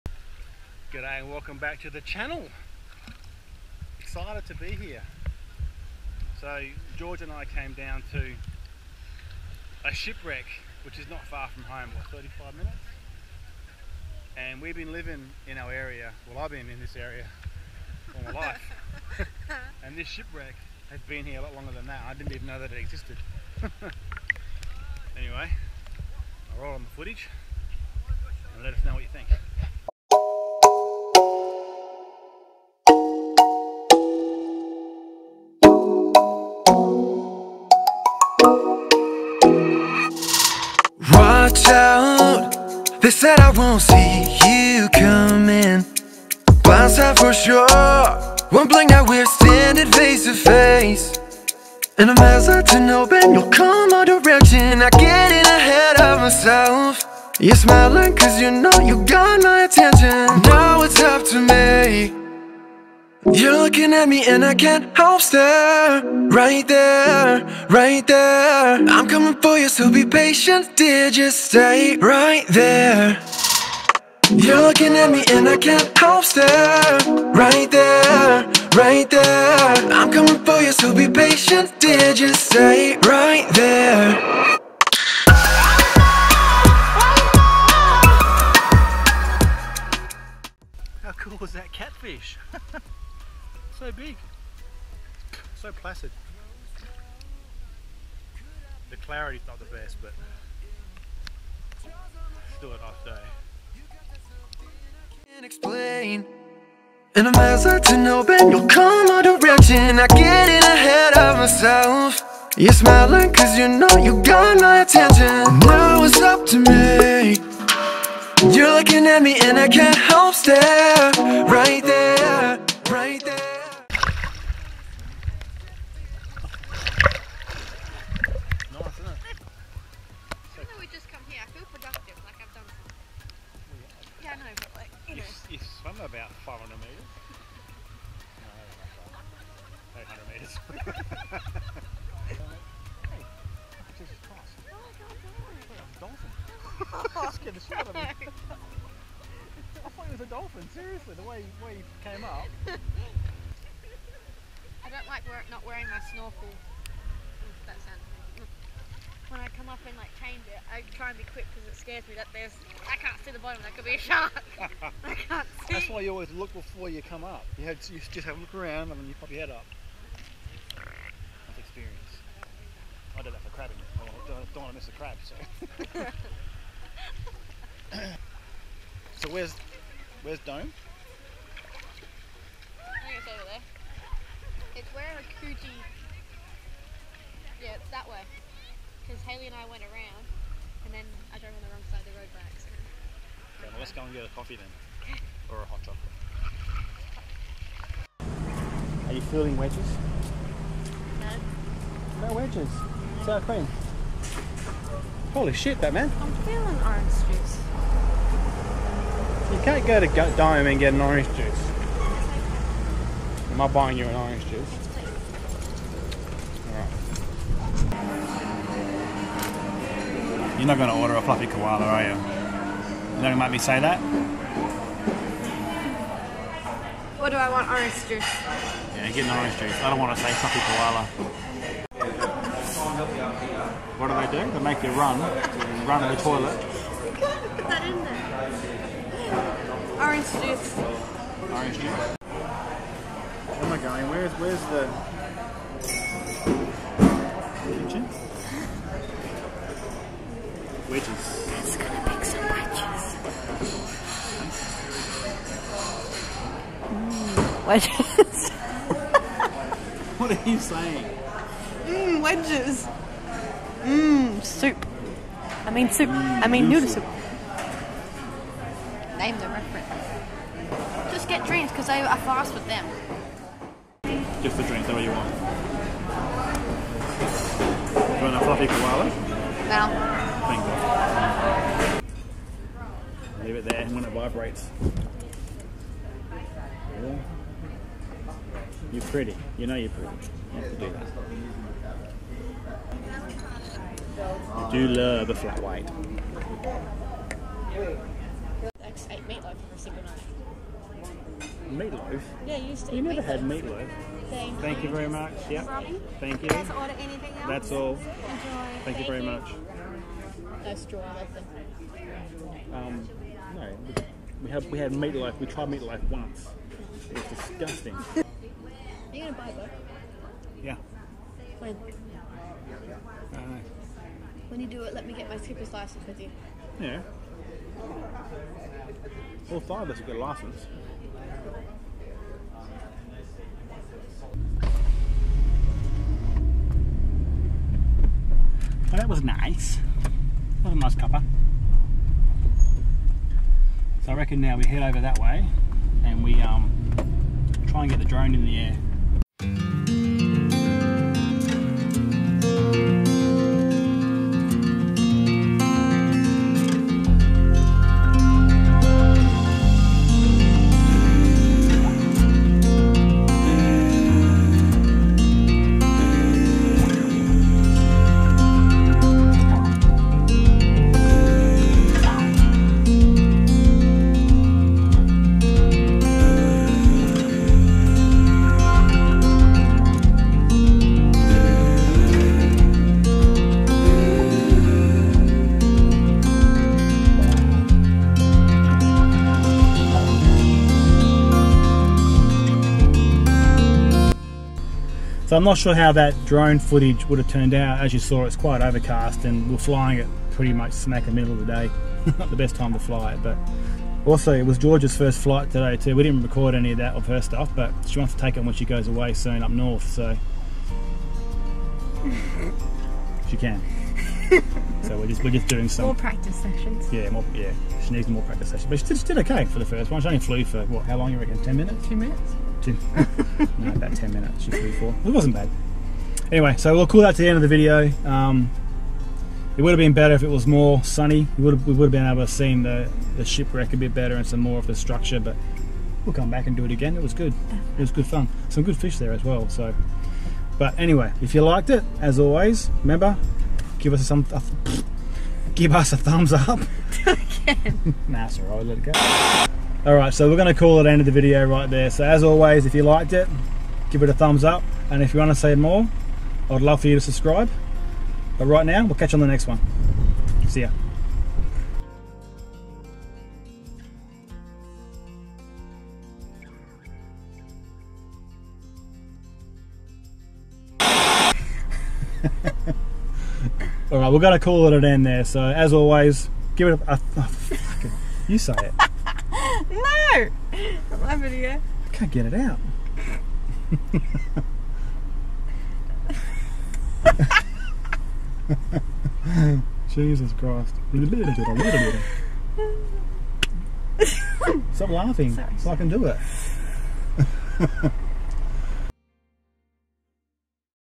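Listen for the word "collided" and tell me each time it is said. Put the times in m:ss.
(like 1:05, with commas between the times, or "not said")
not said.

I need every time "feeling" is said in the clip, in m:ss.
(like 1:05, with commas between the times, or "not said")
3:19, 3:26.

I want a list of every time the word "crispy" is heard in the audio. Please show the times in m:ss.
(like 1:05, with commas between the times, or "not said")
not said.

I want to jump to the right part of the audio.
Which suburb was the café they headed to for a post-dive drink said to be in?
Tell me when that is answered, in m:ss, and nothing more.
3:05.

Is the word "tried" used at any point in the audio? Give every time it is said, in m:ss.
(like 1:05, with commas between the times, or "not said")
5:15.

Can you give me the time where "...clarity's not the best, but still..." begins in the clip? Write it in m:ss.
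1:38.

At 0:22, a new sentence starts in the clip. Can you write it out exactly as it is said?
I didn't even know that it existed.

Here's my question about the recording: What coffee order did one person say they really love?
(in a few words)
Flat white.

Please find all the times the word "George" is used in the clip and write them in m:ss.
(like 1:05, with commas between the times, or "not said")
0:06, 6:44.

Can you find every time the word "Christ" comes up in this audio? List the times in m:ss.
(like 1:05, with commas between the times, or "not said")
8:10.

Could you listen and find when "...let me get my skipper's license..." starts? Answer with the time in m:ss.
5:24.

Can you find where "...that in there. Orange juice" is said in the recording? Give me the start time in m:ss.
3:57.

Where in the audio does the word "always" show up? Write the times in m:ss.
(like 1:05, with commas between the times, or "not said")
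2:46, 7:22, 7:32, 7:55.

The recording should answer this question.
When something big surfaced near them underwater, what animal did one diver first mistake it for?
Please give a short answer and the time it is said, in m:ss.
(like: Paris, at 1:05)
Dolphin, at 2:30.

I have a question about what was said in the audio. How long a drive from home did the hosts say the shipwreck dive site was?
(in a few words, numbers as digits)
35 minutes.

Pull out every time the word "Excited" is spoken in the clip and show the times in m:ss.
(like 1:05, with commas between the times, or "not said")
0:04.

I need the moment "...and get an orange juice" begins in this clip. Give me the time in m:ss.
3:30.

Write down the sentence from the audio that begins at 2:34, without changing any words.
I don't like wear not wearing my snorkel.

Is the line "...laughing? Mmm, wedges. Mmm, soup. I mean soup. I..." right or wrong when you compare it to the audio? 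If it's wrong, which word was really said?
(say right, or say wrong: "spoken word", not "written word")
wrong: "saying", not "laughing".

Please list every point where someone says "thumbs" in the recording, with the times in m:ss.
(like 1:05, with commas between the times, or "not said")
7:25, 7:34.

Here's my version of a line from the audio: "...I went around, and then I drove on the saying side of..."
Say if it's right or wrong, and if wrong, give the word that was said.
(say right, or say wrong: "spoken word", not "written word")
wrong: "wrong", not "saying".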